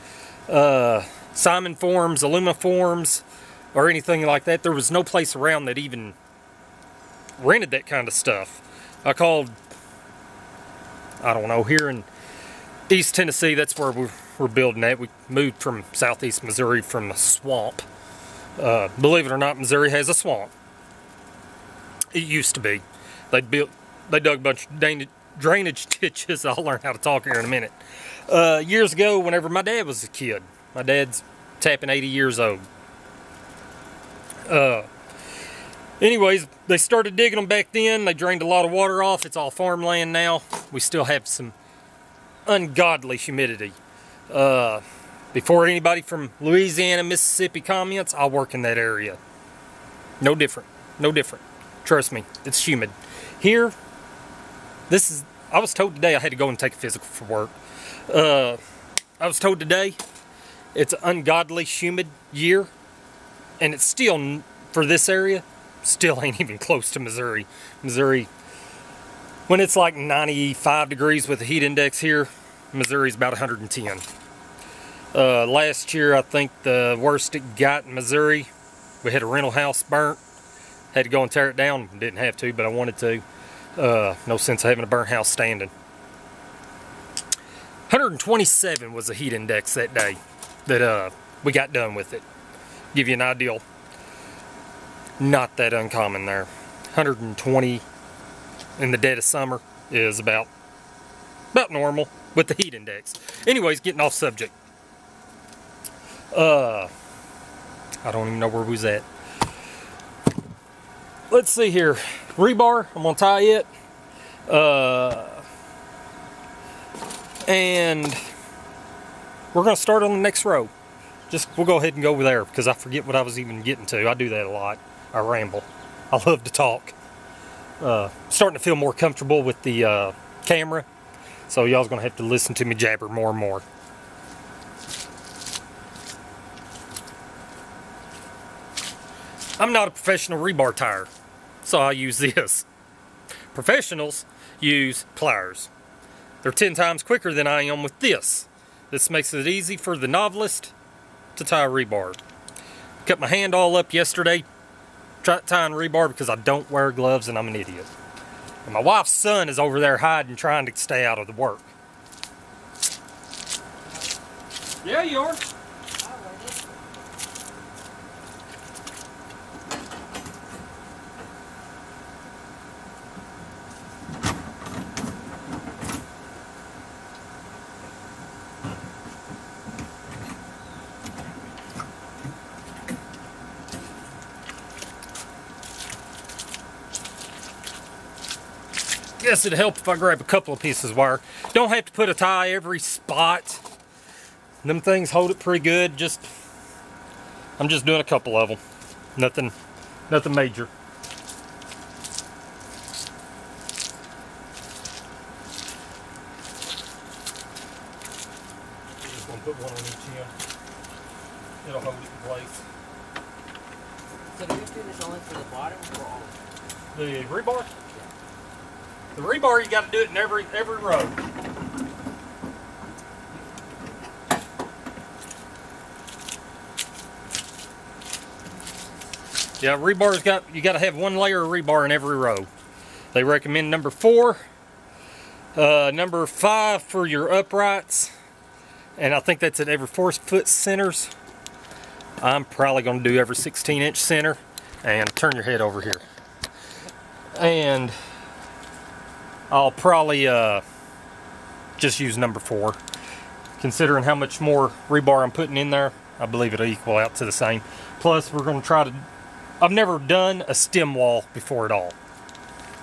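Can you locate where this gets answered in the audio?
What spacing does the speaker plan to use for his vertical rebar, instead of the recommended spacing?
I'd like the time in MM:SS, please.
04:03.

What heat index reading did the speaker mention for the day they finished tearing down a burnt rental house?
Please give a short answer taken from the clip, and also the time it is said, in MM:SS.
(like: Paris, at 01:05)
127, at 01:27.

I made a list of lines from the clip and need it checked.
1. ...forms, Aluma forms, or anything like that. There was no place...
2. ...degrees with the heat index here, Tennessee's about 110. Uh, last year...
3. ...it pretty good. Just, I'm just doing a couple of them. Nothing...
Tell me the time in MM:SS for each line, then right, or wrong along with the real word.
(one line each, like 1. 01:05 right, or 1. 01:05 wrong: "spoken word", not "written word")
1. 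00:01 right
2. 01:10 wrong: "Missouri", not "Tennessee"
3. 03:15 right.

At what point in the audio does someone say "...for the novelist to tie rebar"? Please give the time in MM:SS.
02:29.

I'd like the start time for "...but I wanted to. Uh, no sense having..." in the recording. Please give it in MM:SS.
01:22.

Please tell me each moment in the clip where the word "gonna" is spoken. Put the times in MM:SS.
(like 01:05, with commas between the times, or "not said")
01:53, 01:59, 02:11.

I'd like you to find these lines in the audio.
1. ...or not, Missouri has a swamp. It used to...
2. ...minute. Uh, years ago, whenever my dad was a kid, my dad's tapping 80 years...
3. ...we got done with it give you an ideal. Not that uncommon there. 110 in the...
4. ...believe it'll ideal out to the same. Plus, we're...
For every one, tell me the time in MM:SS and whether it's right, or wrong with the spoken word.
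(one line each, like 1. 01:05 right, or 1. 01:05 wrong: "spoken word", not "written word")
1. 00:19 right
2. 00:27 right
3. 01:31 wrong: "120", not "110"
4. 04:16 wrong: "equal", not "ideal".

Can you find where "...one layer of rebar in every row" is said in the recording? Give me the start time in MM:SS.
03:50.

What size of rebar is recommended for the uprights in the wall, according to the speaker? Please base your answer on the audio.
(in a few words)
number 5.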